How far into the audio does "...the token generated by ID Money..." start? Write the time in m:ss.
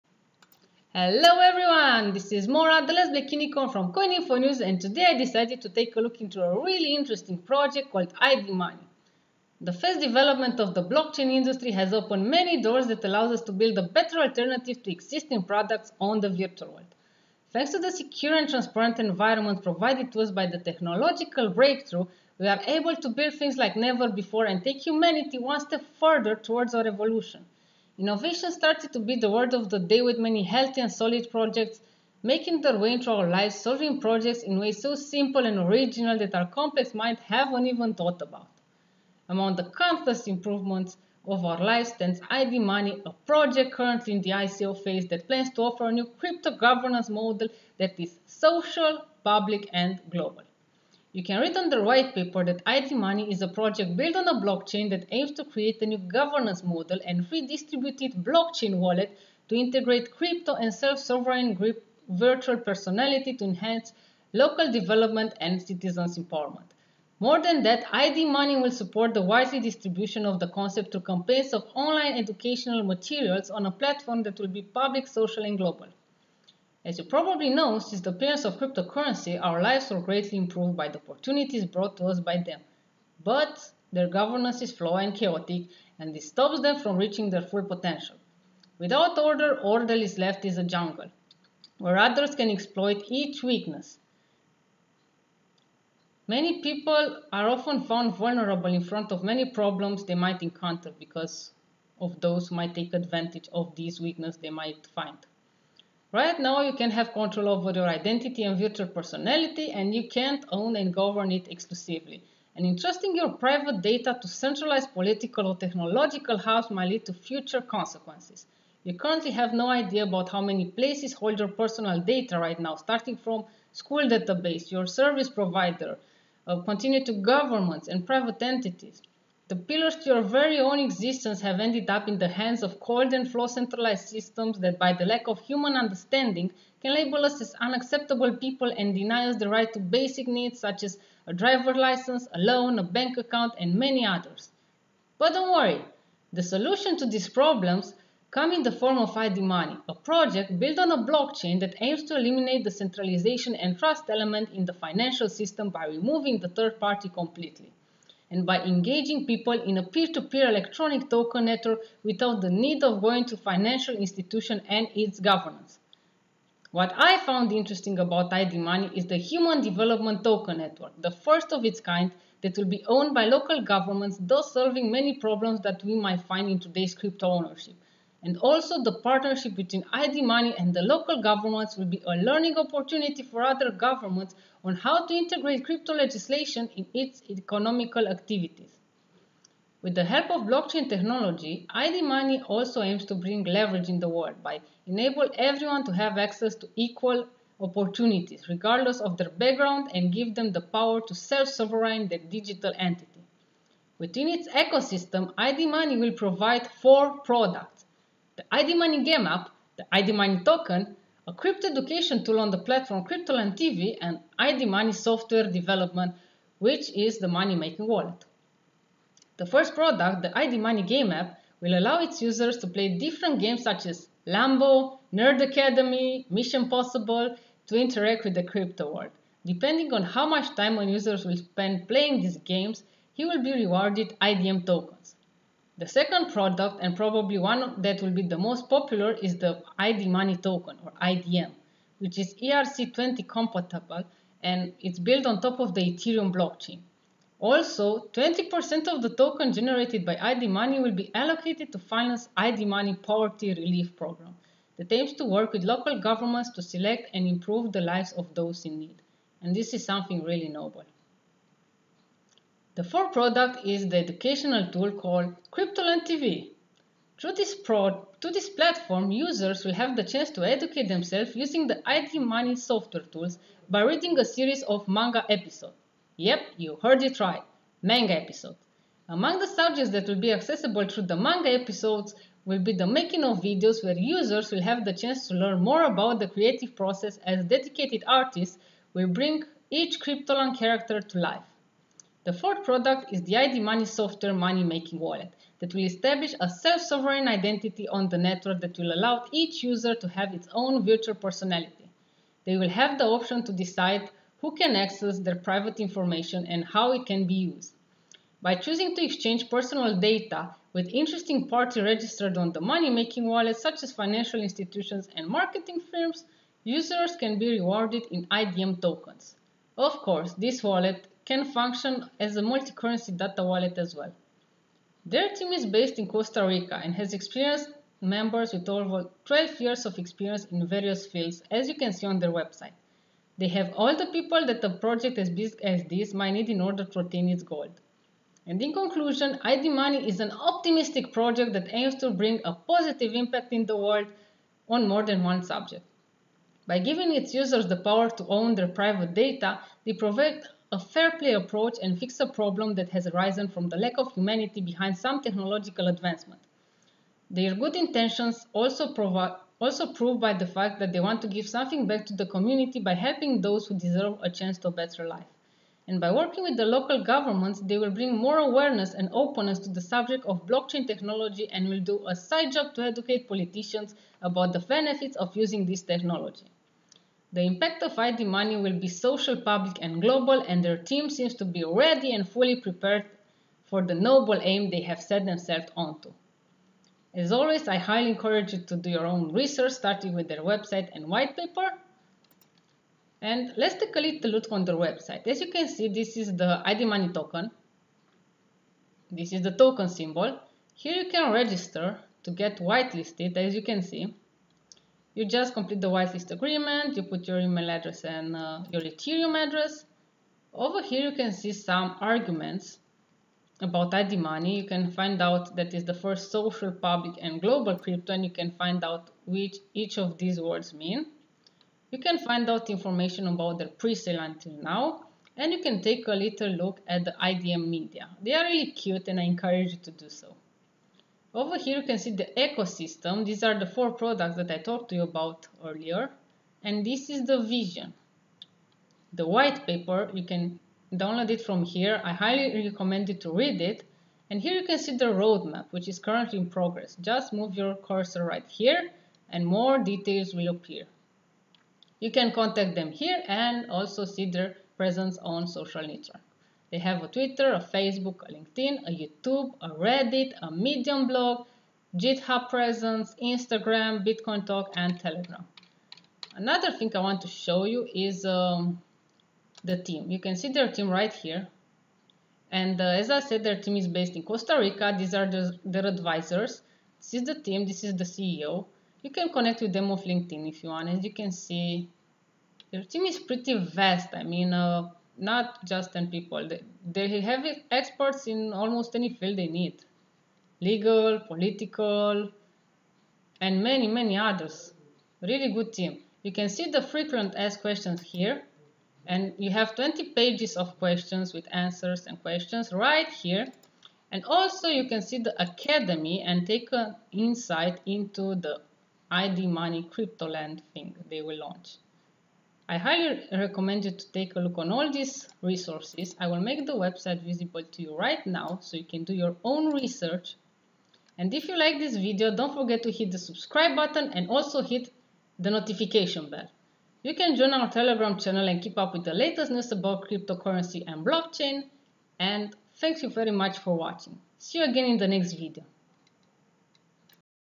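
4:09.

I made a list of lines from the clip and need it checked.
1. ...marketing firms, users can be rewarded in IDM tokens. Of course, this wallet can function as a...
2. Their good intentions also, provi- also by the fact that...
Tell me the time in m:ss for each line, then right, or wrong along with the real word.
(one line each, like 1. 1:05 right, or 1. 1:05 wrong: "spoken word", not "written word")
1. 5:15 right
2. 5:57 right.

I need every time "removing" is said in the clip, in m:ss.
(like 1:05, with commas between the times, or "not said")
2:35.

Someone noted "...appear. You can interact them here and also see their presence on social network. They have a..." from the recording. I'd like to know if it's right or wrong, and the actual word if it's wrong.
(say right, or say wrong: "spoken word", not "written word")
wrong: "contact", not "interact".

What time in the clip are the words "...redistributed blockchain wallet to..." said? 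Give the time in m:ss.
0:57.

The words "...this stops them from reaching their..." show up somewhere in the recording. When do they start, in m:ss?
1:26.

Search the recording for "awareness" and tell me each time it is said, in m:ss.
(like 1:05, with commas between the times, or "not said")
6:08.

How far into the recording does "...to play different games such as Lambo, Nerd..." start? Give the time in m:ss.
3:42.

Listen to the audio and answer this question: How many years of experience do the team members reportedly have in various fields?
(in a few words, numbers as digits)
over 12 years.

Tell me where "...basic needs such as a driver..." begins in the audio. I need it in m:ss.
2:19.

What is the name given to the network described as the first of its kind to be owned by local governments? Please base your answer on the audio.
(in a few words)
Human Development Token Network.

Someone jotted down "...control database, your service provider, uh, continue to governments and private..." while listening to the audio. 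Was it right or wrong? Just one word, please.
wrong.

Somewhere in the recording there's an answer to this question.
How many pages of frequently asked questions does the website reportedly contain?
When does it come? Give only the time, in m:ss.
8:19.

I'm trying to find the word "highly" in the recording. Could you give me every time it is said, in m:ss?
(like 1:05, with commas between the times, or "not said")
6:27, 7:22, 8:32.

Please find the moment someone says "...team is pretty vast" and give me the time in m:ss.
8:02.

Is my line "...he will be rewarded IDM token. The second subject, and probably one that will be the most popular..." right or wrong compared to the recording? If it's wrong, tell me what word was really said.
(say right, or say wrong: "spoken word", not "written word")
wrong: "product", not "subject".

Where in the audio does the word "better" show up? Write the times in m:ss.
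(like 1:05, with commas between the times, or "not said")
0:13, 6:04.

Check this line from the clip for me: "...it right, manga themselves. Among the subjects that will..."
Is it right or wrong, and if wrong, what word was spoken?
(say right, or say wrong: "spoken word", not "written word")
wrong: "episodes", not "themselves".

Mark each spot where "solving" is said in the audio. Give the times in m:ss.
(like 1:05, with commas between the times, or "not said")
0:33, 2:54.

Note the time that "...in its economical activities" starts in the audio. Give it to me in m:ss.
3:06.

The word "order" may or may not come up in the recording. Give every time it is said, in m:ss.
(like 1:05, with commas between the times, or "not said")
1:29, 5:36.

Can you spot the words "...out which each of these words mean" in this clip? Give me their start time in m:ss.
6:58.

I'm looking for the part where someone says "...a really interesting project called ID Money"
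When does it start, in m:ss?
0:06.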